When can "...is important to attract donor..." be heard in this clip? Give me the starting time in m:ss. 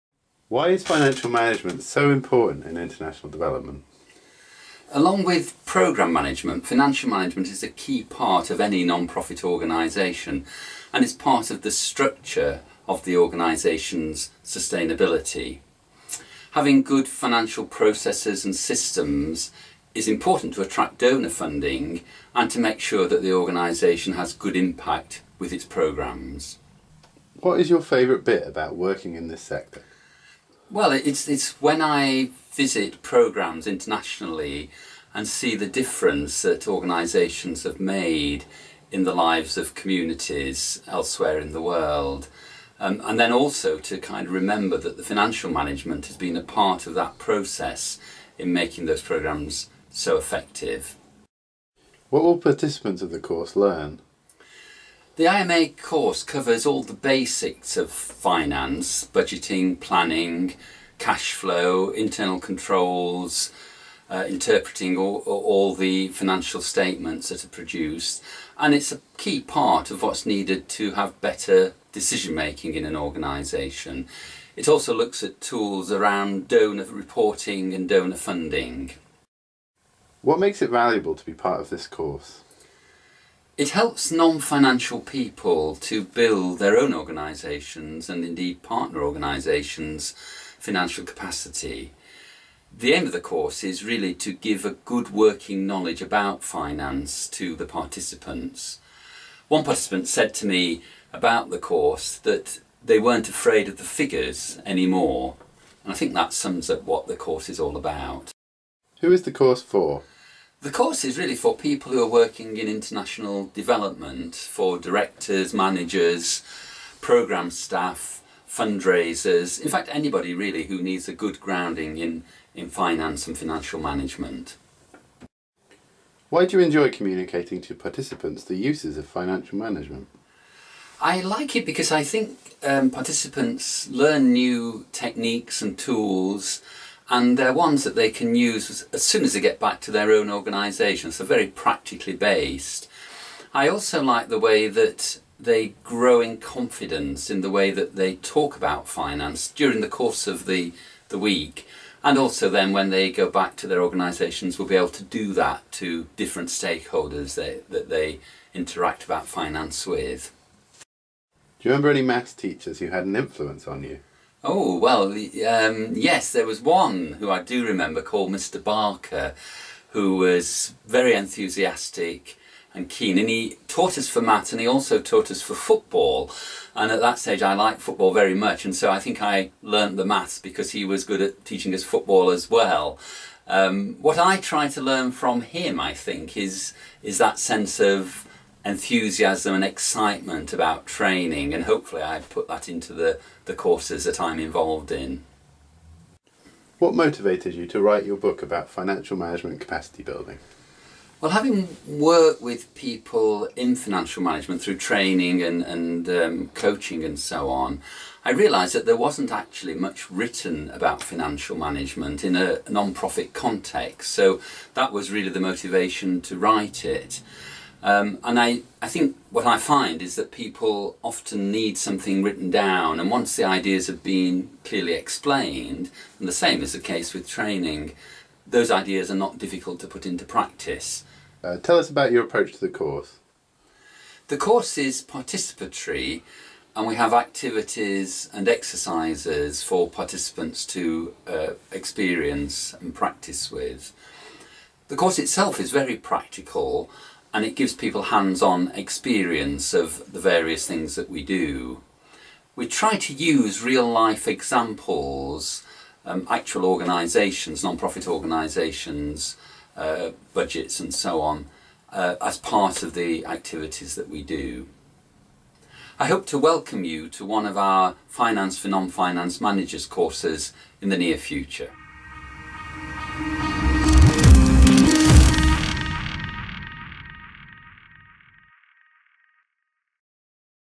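0:19.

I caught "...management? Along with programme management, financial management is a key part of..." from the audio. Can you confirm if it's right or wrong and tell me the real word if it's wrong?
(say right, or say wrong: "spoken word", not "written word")
wrong: "development", not "management".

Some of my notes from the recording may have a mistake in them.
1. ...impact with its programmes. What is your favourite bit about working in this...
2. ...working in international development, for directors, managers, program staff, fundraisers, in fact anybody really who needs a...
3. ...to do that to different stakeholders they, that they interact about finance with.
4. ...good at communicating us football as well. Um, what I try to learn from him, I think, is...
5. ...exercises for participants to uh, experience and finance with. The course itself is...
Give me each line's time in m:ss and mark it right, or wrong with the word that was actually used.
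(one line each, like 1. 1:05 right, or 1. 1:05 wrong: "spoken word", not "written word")
1. 0:24 right
2. 1:52 right
3. 2:34 right
4. 3:01 wrong: "teaching", not "communicating"
5. 3:58 wrong: "practice", not "finance".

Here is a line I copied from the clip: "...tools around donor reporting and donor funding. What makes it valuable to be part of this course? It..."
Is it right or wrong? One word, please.
right.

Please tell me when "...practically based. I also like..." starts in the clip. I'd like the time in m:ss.
2:21.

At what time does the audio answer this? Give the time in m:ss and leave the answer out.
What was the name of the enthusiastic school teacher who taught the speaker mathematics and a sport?
2:48.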